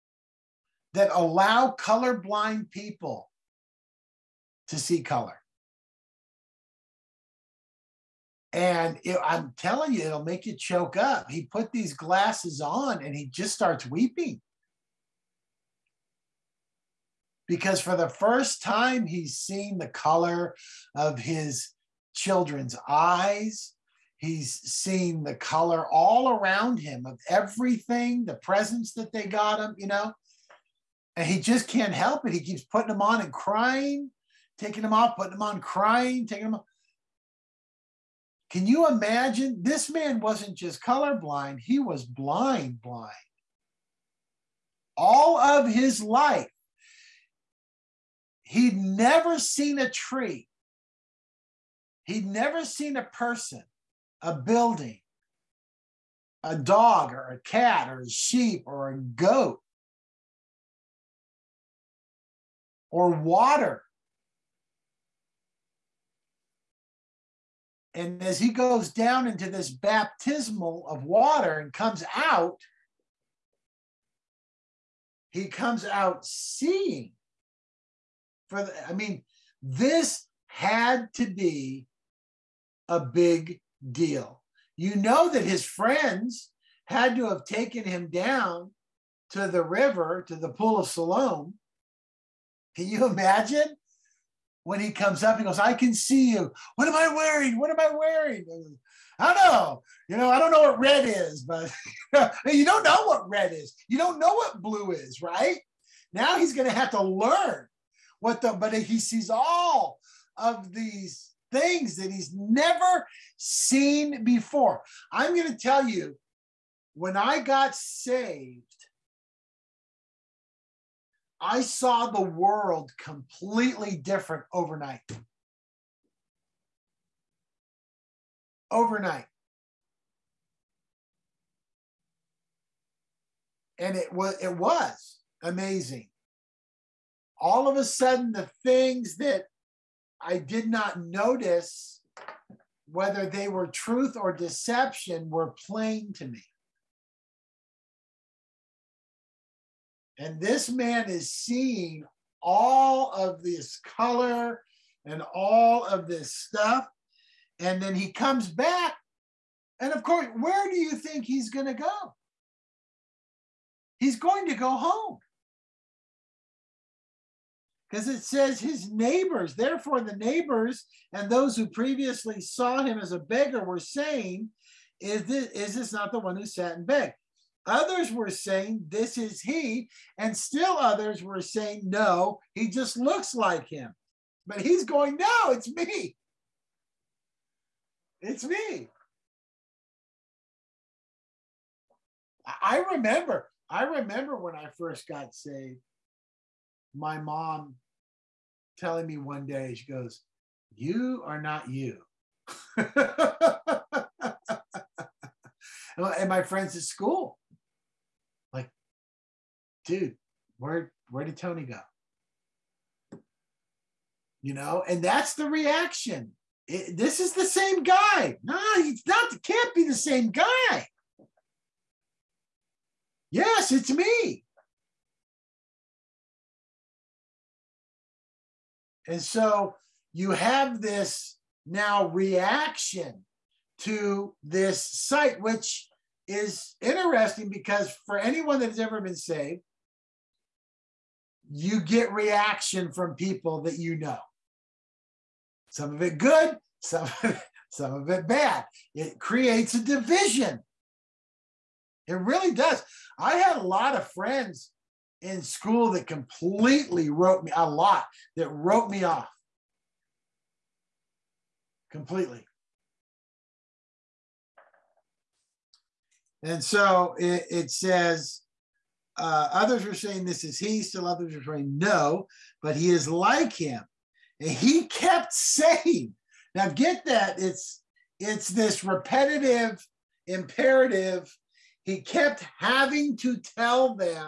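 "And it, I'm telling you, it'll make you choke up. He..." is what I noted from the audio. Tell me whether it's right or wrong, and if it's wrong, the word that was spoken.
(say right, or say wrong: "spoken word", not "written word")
right.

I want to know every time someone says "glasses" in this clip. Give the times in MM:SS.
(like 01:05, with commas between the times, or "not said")
00:11.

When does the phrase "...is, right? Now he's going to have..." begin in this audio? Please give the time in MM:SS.
01:44.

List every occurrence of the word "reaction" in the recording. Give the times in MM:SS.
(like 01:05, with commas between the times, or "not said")
03:35, 03:52, 04:02.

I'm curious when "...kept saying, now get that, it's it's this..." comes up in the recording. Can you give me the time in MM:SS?
04:34.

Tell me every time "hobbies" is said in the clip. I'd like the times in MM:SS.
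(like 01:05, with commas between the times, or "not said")
not said.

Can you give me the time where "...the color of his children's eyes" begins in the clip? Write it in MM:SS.
00:19.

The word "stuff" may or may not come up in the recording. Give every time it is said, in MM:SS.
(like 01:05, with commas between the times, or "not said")
02:36.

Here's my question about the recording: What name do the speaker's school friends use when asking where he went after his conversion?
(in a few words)
Tony.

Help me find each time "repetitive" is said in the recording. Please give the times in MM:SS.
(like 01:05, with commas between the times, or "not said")
04:38.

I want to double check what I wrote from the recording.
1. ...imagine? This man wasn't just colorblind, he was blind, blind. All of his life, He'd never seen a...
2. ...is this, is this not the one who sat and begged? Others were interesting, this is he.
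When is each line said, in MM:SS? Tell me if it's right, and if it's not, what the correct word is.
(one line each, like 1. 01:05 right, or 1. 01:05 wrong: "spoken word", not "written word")
1. 00:38 right
2. 02:54 wrong: "saying", not "interesting".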